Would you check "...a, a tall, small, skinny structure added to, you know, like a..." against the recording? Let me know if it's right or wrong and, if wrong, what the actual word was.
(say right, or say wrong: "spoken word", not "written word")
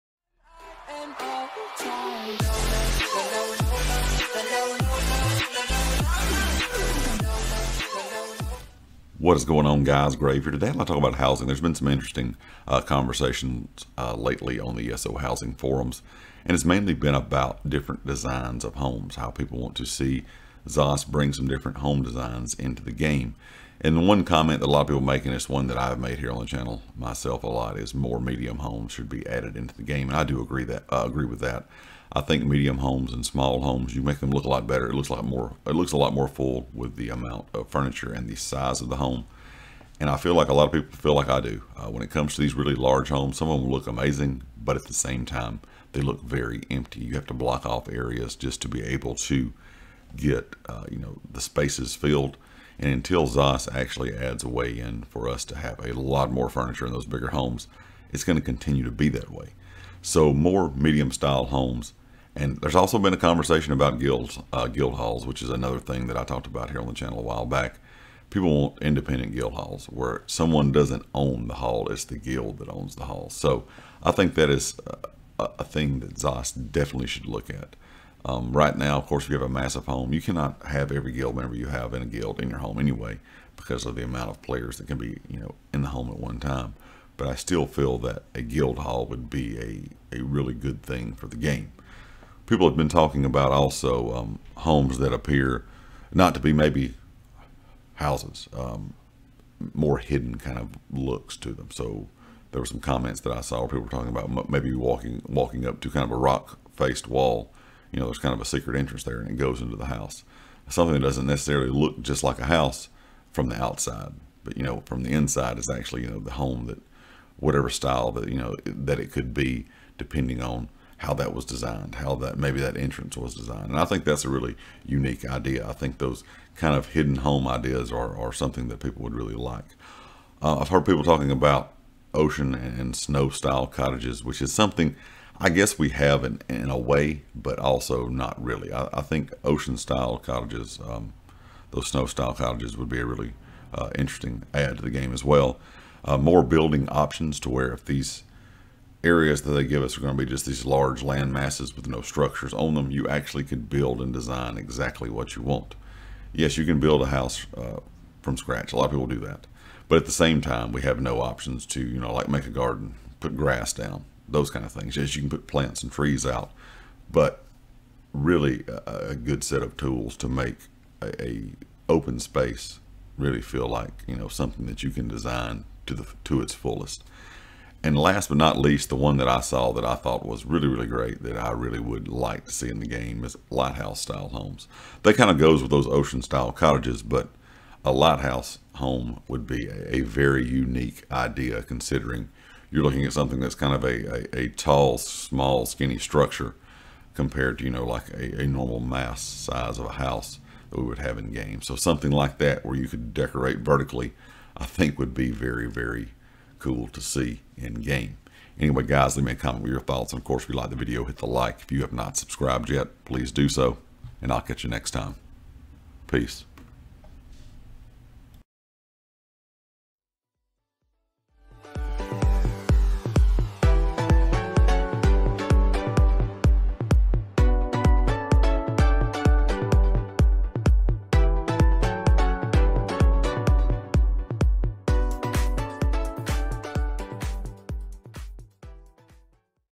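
wrong: "compared", not "added".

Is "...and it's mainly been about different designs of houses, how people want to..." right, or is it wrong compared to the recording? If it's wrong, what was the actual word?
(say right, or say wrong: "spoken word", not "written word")
wrong: "homes", not "houses".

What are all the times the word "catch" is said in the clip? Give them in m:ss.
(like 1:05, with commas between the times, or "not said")
3:34.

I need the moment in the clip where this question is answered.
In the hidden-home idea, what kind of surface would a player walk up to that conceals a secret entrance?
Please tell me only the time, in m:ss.
1:46.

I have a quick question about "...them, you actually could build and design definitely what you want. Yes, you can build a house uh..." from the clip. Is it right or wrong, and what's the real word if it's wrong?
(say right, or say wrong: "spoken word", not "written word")
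wrong: "exactly", not "definitely".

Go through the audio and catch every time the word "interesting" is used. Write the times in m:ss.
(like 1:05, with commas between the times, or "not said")
0:11, 2:23.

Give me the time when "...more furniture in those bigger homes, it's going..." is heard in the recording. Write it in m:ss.
0:56.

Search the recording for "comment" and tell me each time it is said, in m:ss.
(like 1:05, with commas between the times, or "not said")
0:24, 1:42, 3:29.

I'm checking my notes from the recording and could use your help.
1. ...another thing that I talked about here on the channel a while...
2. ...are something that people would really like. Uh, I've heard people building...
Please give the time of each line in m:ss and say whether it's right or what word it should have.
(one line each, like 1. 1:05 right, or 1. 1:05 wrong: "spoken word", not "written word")
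1. 1:05 right
2. 2:08 wrong: "talking", not "building".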